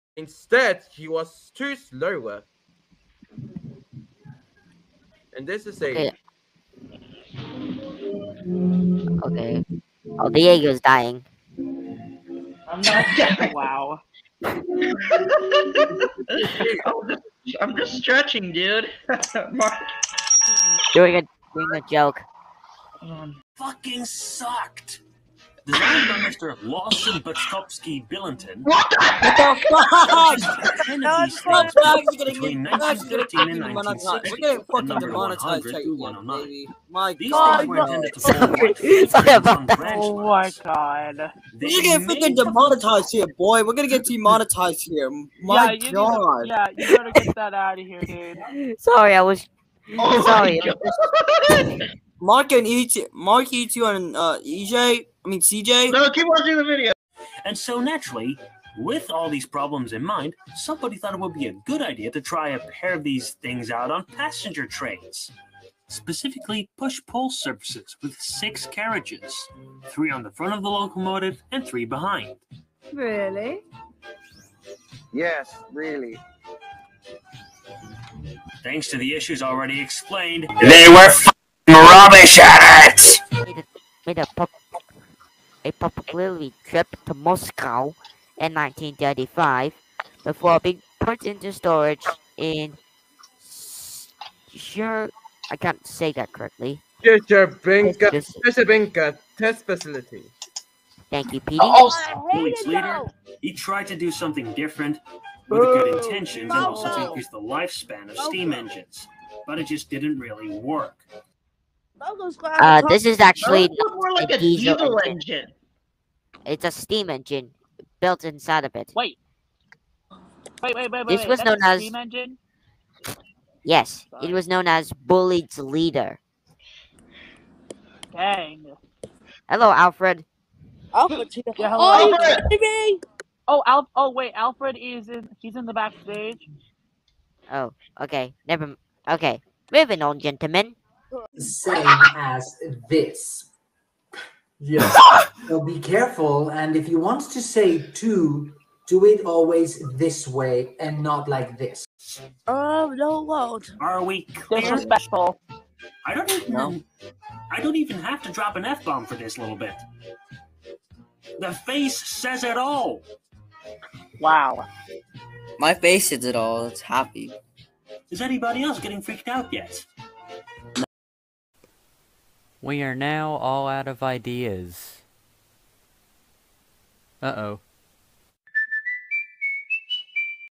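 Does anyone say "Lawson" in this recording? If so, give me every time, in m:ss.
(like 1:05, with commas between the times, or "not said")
0:26.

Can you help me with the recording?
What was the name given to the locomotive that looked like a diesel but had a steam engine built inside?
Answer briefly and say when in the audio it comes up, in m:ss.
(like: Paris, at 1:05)
Bulleid's leader, at 2:05.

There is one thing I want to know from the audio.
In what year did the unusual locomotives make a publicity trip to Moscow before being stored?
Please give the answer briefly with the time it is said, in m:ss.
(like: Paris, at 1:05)
1935, at 1:28.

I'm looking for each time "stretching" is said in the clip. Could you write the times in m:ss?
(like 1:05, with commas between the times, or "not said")
0:17.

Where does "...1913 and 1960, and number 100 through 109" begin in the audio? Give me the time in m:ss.
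0:32.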